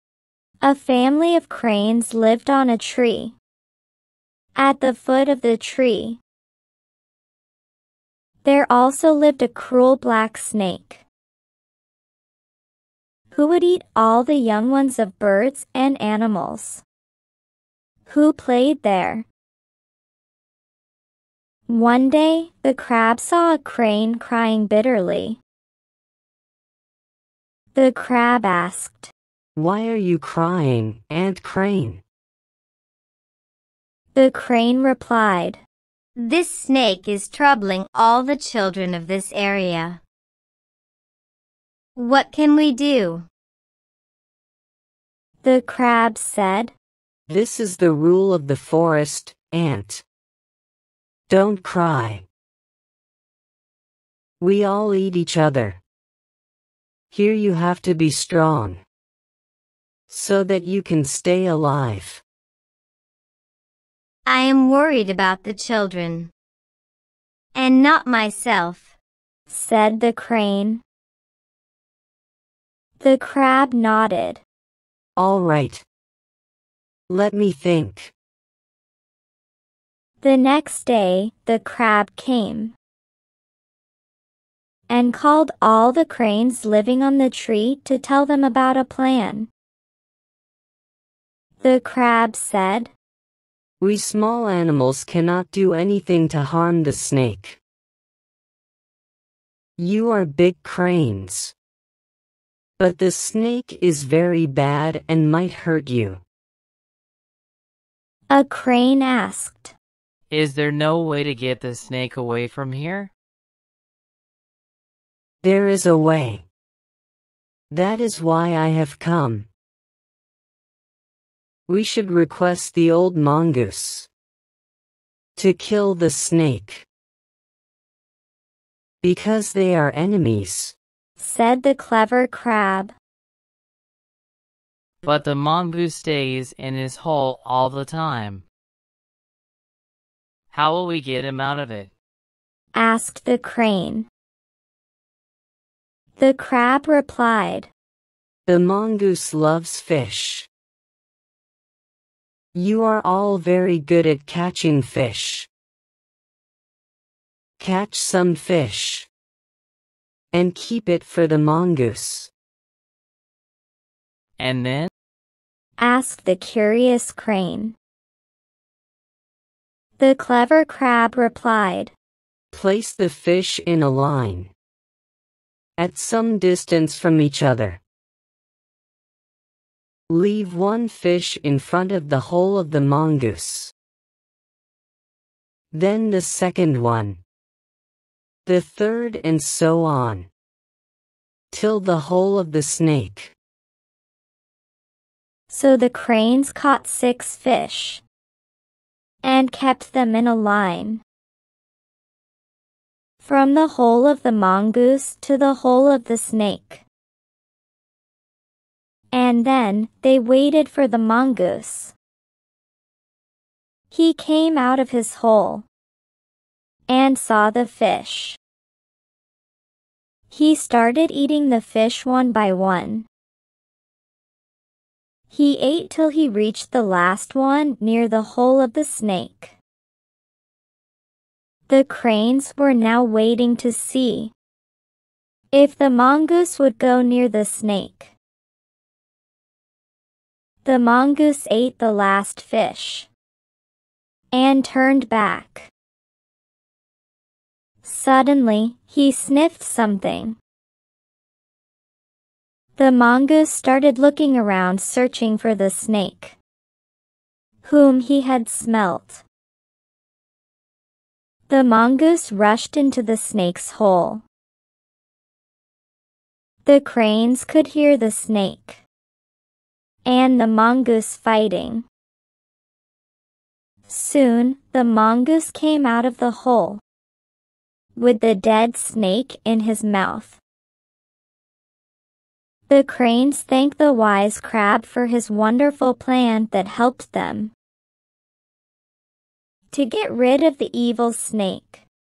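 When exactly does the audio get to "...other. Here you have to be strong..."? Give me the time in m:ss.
0:55.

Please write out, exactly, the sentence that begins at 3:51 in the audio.
The cranes were now waiting to see if the mongoose would go near the snake.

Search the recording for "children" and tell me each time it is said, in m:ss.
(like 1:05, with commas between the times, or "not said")
0:38, 1:05.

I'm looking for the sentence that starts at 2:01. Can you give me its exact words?
We should request the old mongoose to kill the snake.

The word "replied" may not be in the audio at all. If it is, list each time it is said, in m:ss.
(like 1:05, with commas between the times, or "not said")
0:34, 2:26, 2:51.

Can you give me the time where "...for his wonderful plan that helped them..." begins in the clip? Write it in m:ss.
4:44.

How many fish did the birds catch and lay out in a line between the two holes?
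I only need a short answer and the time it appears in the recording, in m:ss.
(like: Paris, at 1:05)
6, at 3:16.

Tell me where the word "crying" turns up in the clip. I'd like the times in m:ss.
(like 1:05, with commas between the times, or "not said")
0:24, 0:30.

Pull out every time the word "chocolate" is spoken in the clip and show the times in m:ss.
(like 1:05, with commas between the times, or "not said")
not said.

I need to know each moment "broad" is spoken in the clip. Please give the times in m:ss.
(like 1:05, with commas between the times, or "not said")
not said.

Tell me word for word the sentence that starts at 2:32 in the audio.
You are all very good at catching fish.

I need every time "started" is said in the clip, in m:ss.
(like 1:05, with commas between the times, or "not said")
3:40, 4:13.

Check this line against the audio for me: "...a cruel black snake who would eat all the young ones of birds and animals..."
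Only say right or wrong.
right.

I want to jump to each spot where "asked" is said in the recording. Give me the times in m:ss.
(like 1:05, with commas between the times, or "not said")
0:28, 1:49, 2:22, 2:45.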